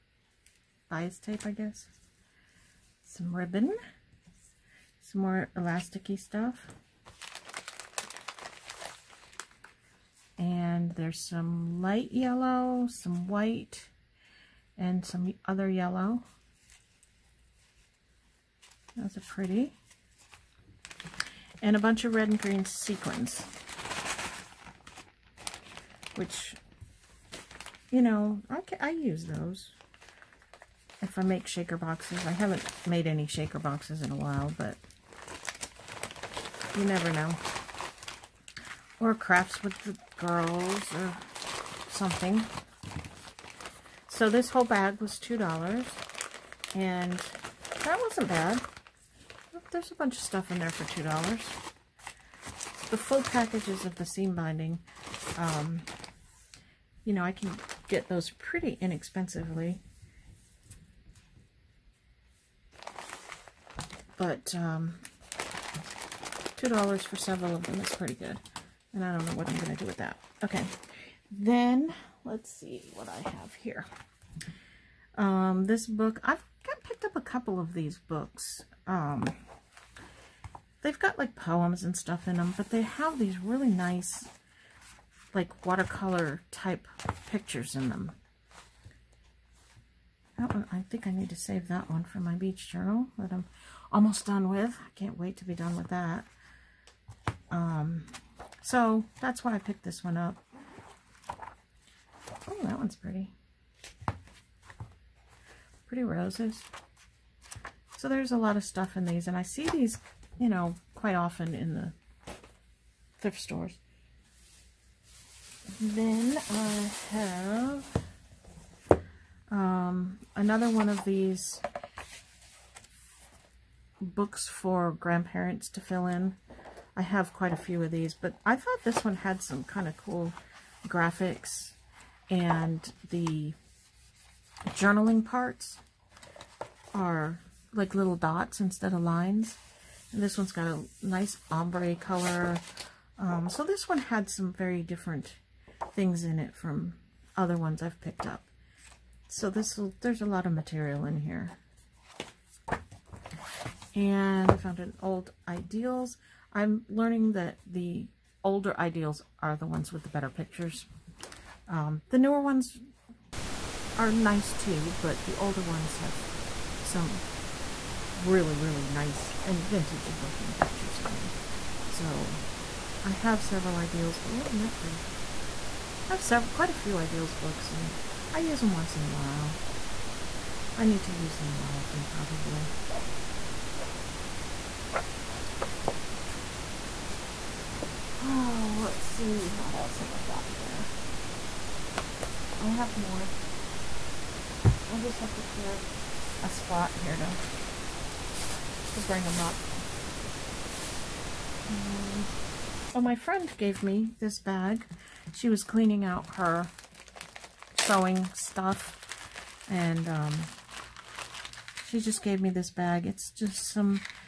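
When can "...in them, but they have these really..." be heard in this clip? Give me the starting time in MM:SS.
01:22.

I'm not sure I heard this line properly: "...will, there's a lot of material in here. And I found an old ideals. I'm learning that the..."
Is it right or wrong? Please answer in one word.
right.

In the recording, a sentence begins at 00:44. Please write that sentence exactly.
So this whole bag was $2, and that wasn't bad.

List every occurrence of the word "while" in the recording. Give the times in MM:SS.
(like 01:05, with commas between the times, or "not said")
00:34, 02:59.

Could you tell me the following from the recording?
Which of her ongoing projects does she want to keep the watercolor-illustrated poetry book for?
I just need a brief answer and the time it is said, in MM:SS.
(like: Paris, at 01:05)
beach journal, at 01:32.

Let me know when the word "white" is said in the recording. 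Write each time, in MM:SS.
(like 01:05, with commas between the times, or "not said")
00:13.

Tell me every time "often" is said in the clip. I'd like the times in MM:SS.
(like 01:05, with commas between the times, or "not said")
01:51, 03:01.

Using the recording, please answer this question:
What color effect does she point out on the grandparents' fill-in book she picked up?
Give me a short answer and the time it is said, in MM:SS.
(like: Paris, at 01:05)
ombre, at 02:21.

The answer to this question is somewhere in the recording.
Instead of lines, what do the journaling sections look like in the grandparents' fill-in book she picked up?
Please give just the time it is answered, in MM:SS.
02:17.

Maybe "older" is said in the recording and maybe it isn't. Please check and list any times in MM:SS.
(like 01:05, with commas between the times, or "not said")
02:38, 02:45.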